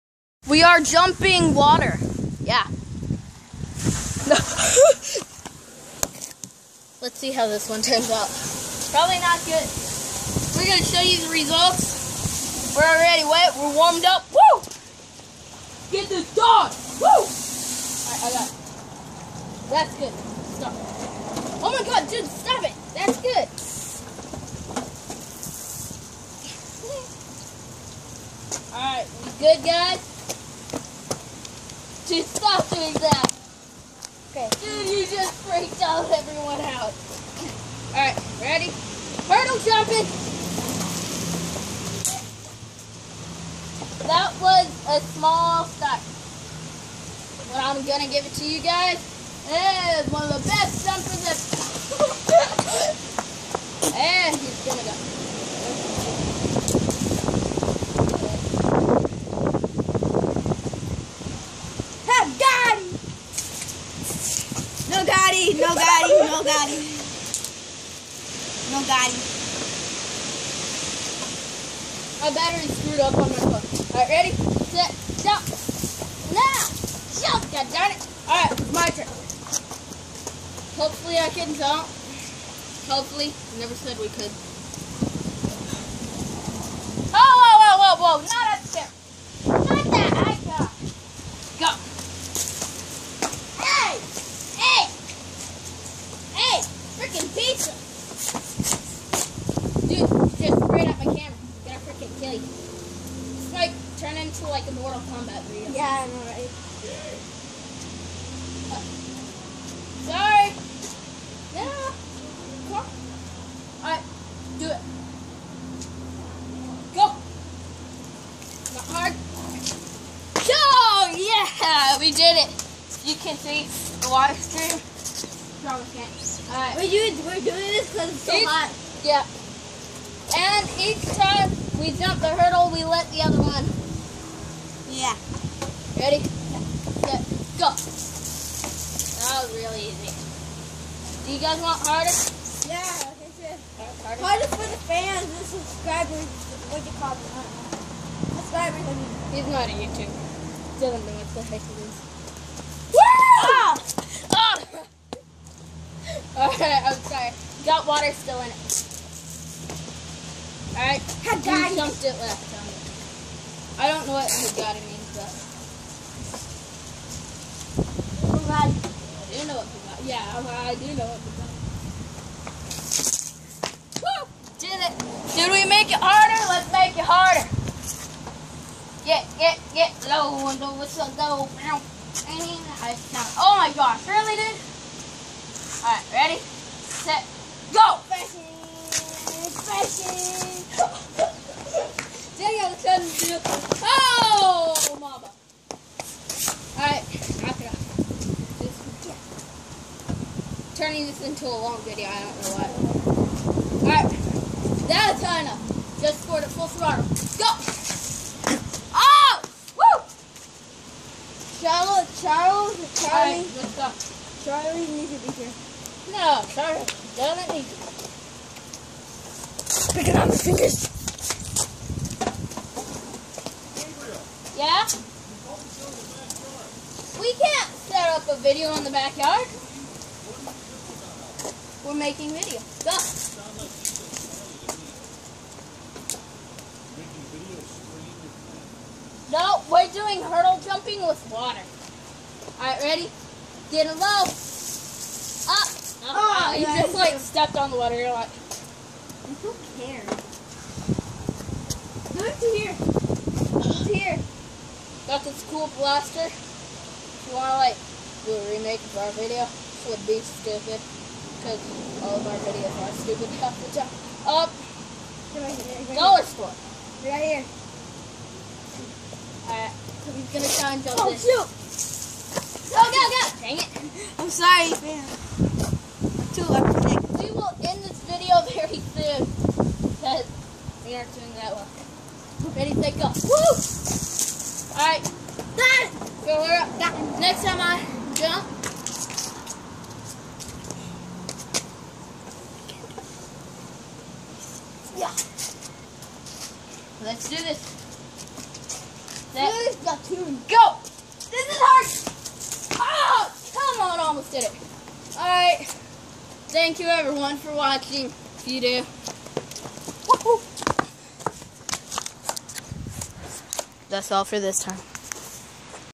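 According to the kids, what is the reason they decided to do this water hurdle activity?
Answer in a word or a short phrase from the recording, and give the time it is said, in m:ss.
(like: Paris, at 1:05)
Because it's so hot, at 2:07.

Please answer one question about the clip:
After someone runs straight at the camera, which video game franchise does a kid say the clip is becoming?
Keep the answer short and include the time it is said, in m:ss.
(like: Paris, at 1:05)
Mortal Kombat, at 1:44.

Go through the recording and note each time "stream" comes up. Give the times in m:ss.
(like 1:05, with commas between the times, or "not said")
2:04.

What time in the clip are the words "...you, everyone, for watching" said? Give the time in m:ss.
5:06.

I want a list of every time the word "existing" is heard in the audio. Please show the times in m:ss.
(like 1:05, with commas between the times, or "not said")
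not said.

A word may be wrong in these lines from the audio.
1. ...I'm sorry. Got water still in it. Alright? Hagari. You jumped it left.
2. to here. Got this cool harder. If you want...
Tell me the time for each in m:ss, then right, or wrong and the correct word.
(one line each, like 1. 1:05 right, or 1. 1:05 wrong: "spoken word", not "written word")
1. 2:36 right
2. 4:13 wrong: "blaster", not "harder".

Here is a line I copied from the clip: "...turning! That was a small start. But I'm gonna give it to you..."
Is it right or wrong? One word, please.
wrong.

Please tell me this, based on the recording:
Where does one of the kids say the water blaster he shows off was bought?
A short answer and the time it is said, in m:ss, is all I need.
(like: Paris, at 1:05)
Dollar store, at 4:25.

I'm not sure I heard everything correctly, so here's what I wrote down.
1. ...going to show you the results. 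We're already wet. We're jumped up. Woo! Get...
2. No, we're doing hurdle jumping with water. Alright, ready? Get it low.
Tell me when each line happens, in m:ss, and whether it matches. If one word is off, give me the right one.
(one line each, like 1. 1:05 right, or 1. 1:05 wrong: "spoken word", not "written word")
1. 0:10 wrong: "warmed", not "jumped"
2. 3:59 right.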